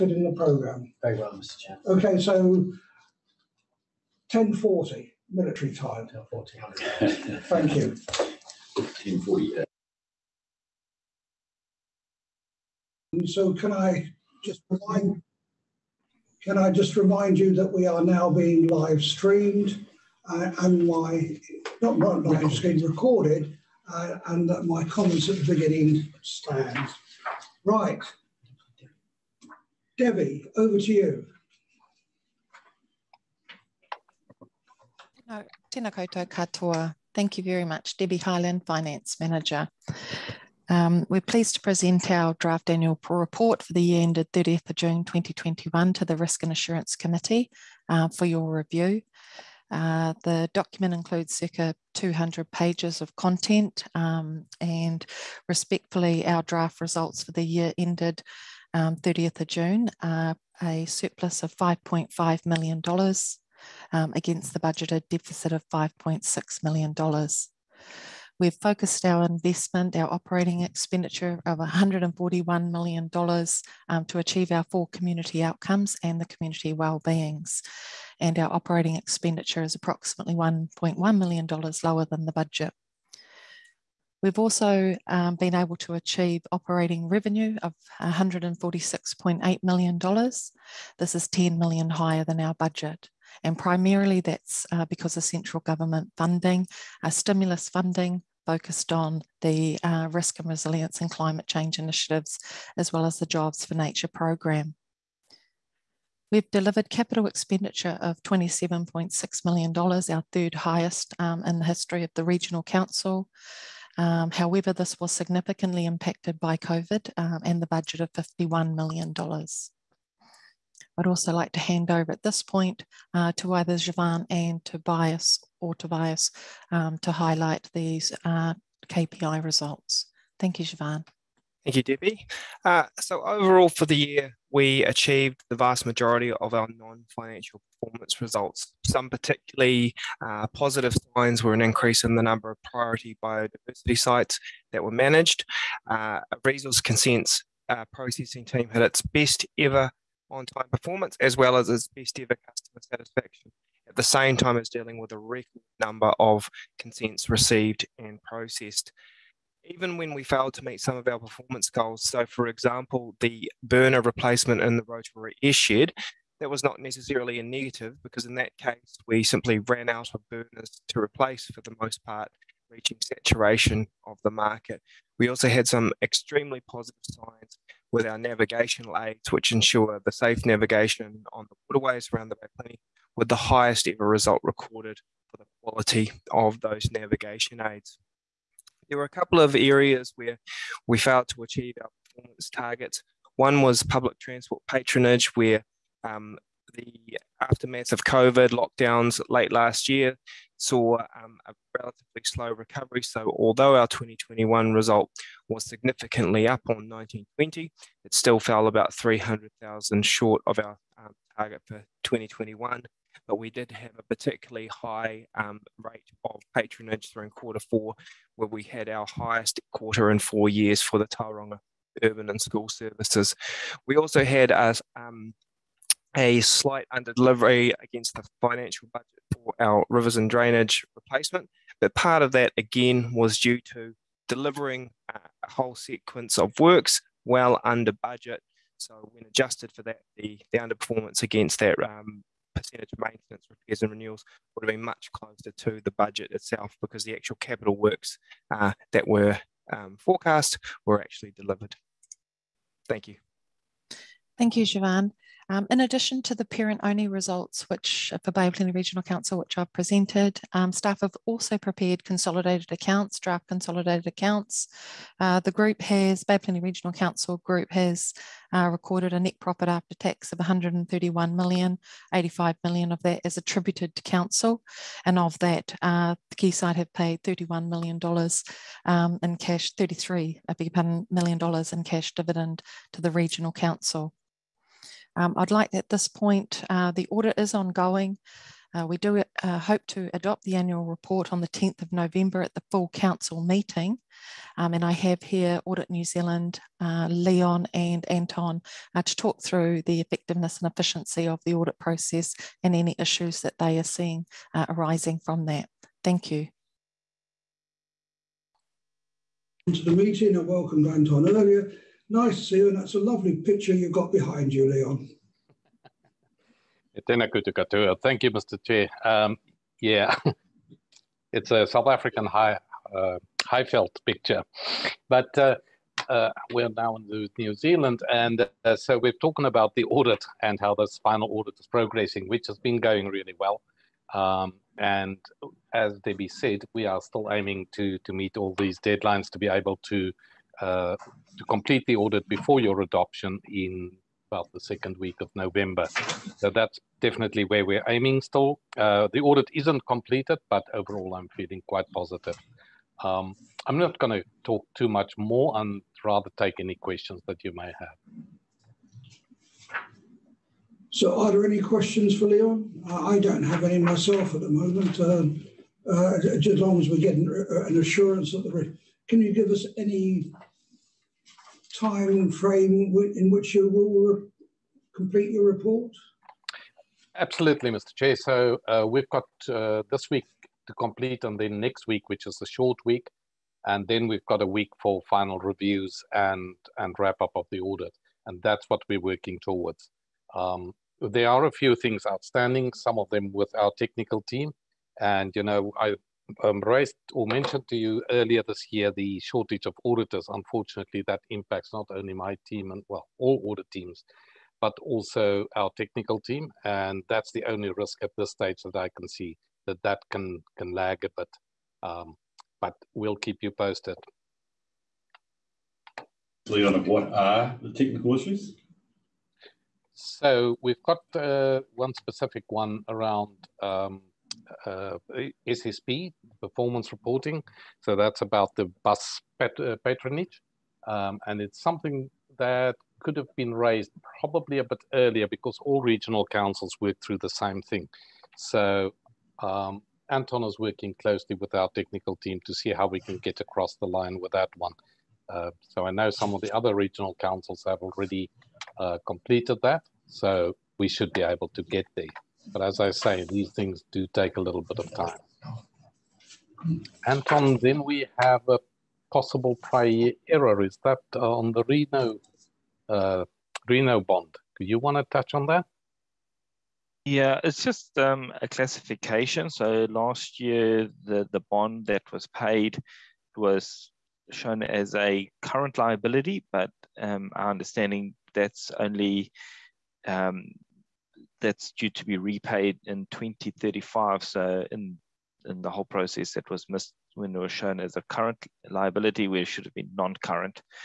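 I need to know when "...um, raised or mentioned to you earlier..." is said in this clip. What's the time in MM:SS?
06:36.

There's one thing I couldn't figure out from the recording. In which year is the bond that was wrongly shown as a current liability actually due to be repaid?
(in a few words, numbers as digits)
2035.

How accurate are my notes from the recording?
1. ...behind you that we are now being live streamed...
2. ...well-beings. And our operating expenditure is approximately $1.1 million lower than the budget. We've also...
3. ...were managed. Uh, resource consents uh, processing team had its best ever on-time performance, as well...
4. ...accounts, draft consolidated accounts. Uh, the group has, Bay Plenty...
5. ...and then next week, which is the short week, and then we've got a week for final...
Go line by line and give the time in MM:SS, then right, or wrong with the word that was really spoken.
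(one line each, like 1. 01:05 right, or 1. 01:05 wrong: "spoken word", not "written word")
1. 00:16 wrong: "remind", not "behind"
2. 01:16 right
3. 02:24 right
4. 04:22 right
5. 06:21 right.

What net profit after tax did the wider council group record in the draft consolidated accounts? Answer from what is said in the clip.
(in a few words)
131 million.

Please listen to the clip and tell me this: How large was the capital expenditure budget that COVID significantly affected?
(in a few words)
$51 million.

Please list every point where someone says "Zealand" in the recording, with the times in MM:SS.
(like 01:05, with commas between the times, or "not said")
04:56, 05:27.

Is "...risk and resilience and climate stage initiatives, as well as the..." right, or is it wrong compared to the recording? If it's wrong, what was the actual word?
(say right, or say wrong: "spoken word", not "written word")
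wrong: "change", not "stage".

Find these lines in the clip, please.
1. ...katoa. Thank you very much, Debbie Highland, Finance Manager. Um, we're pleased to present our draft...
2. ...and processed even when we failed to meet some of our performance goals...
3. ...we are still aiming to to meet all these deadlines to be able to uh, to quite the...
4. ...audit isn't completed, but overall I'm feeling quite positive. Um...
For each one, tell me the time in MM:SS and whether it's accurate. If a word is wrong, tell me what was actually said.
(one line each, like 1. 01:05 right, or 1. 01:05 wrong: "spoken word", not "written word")
1. 00:36 right
2. 02:37 right
3. 05:36 wrong: "complete", not "quite"
4. 05:49 right.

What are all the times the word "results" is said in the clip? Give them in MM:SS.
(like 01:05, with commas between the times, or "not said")
00:56, 02:09, 02:18, 03:04, 03:24, 04:17.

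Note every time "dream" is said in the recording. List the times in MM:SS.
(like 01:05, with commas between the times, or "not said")
not said.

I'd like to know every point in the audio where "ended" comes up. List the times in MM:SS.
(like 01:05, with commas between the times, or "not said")
00:44, 00:57.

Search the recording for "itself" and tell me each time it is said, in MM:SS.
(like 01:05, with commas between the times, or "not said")
04:06.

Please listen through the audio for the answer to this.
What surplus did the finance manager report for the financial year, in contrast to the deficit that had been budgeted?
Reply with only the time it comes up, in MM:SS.
01:00.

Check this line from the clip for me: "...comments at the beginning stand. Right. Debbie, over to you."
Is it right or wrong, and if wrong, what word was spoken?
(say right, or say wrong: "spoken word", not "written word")
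right.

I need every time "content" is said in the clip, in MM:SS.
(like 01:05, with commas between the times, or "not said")
00:53.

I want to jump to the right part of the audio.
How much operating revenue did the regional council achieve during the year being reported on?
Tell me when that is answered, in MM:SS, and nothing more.
01:28.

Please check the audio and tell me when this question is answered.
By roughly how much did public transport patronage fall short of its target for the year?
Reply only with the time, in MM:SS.
03:28.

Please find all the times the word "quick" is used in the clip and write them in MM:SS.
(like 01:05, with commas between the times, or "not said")
not said.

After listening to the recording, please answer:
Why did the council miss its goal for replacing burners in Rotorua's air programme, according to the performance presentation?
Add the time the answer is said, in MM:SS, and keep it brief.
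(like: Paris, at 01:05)
ran out of burners, at 02:49.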